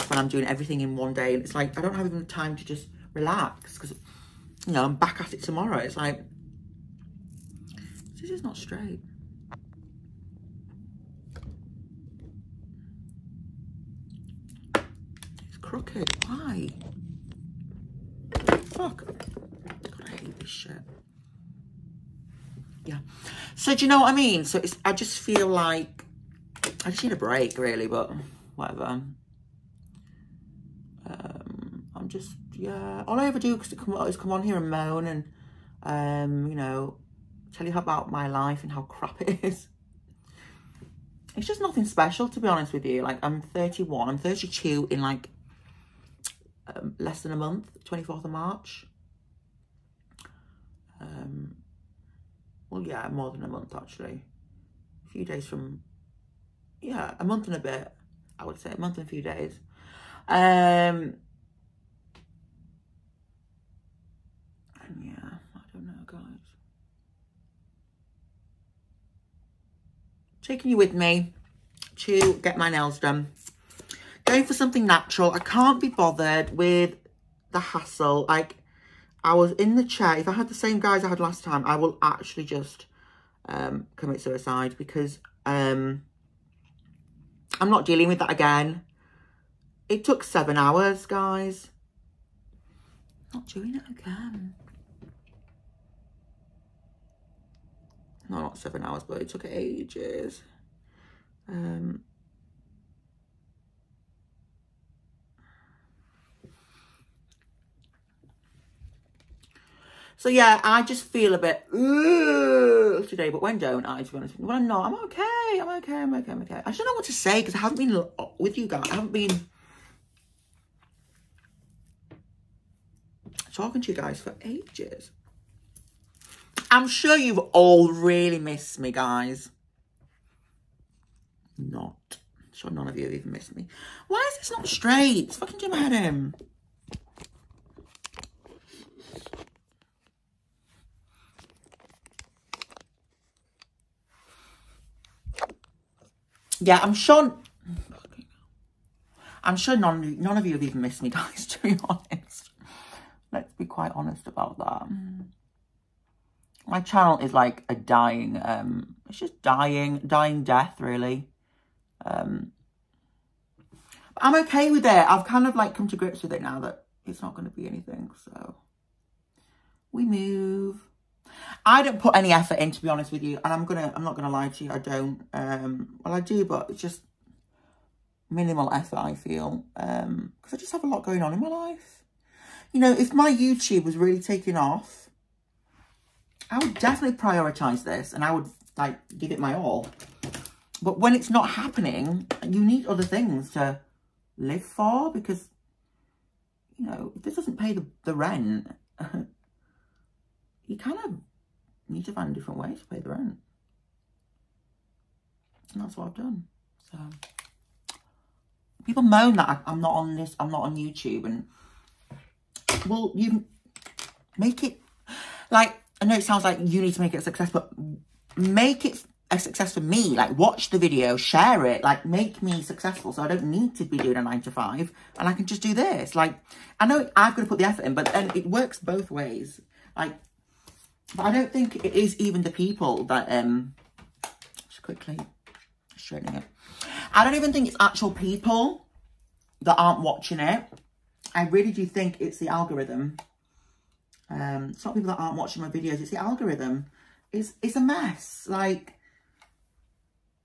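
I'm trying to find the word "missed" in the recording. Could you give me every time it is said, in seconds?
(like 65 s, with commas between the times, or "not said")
128 s, 133 s, 150 s.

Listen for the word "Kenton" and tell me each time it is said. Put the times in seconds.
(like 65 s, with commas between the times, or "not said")
not said.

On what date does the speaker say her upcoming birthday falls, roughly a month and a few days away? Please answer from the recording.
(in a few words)
24th of March.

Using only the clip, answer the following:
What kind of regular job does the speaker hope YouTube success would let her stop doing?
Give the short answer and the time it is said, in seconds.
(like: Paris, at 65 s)
nine to five, at 224 s.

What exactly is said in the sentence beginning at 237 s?
I don't even think it's actual people that aren't watching it.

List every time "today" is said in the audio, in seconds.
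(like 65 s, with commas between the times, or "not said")
113 s.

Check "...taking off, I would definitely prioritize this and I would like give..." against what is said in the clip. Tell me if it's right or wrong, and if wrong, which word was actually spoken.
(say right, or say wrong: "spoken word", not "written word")
right.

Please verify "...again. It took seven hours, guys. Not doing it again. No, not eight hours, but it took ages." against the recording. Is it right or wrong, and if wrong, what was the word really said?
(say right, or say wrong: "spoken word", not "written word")
wrong: "seven", not "eight".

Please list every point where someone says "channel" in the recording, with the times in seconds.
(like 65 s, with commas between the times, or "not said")
156 s.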